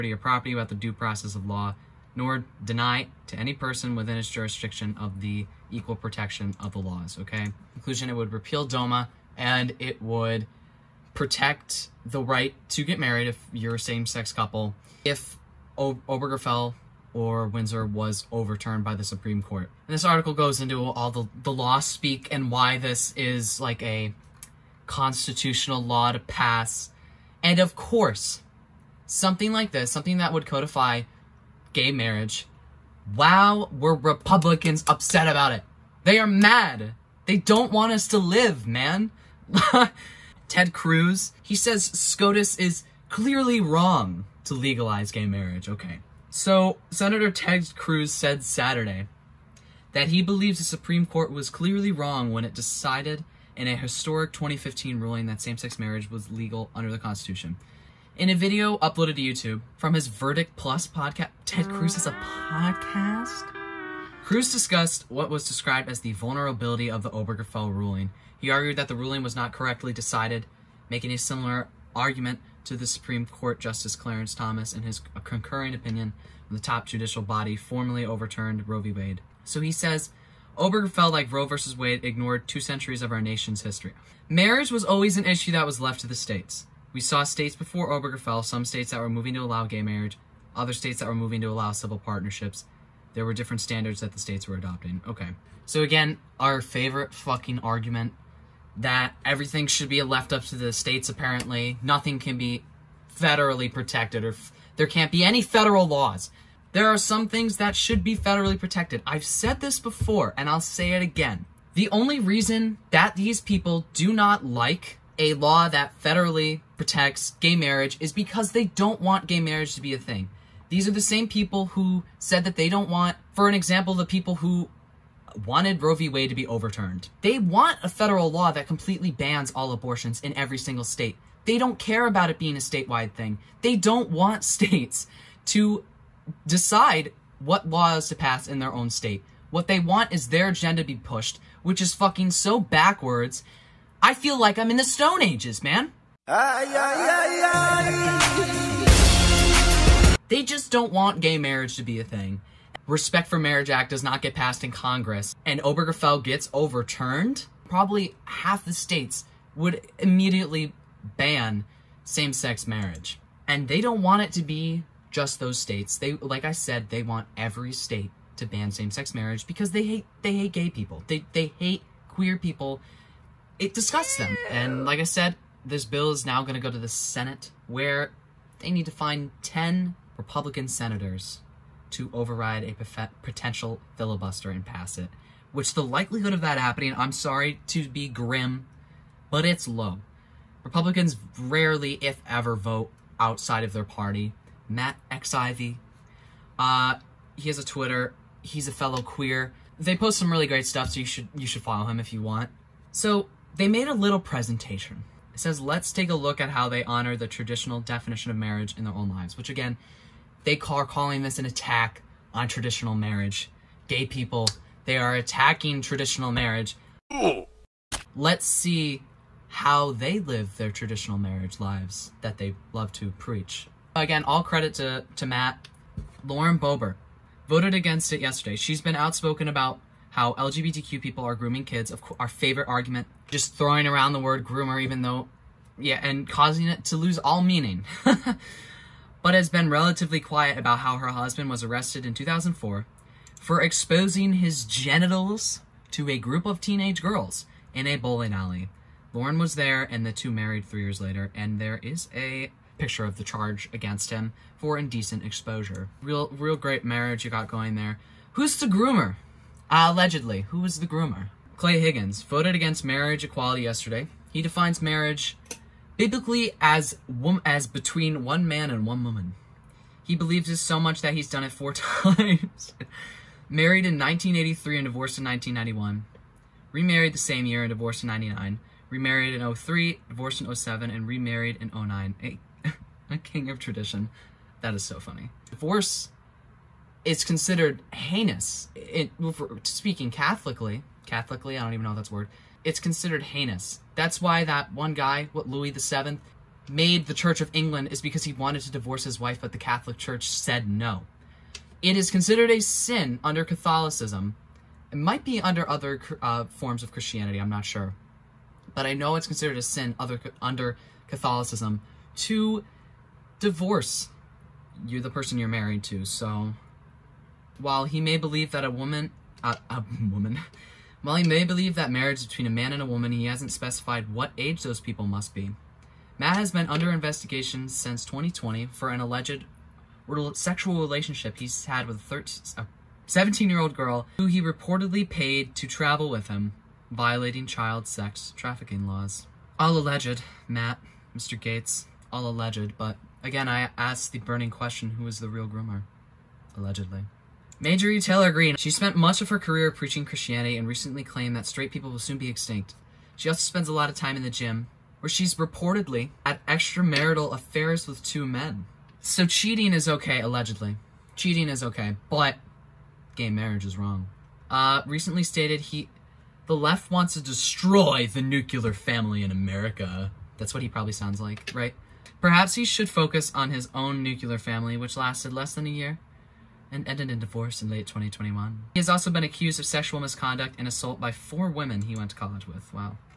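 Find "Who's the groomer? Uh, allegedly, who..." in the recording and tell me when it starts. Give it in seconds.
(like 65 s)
258 s.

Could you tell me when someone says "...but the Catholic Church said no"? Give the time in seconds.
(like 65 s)
299 s.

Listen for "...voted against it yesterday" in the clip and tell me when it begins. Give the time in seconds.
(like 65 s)
227 s.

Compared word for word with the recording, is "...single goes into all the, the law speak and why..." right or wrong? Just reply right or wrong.
wrong.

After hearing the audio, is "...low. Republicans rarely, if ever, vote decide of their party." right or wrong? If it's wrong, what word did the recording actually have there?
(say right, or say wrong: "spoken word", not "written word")
wrong: "outside", not "decide".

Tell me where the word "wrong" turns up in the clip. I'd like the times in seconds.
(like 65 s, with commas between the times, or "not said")
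43 s, 51 s, 363 s.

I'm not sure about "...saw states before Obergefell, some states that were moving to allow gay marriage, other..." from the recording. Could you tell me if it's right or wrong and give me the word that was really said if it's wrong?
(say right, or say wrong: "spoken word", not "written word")
right.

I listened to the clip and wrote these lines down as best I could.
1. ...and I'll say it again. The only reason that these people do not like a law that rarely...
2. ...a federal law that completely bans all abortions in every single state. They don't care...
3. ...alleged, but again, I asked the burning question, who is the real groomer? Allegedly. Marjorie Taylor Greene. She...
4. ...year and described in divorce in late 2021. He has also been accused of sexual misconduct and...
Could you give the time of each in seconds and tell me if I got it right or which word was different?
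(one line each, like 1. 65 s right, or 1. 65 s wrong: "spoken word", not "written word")
1. 110 s wrong: "federally", not "rarely"
2. 127 s right
3. 342 s right
4. 375 s wrong: "ended", not "described".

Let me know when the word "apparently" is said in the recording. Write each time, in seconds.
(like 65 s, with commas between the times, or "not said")
101 s.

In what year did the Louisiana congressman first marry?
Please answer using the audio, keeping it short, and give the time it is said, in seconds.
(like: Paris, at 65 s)
1983, at 273 s.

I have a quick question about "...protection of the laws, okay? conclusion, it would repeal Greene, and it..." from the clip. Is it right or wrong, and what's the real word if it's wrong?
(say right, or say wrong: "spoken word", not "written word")
wrong: "DOMA", not "Greene".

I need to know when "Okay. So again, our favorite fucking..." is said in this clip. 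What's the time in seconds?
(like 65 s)
95 s.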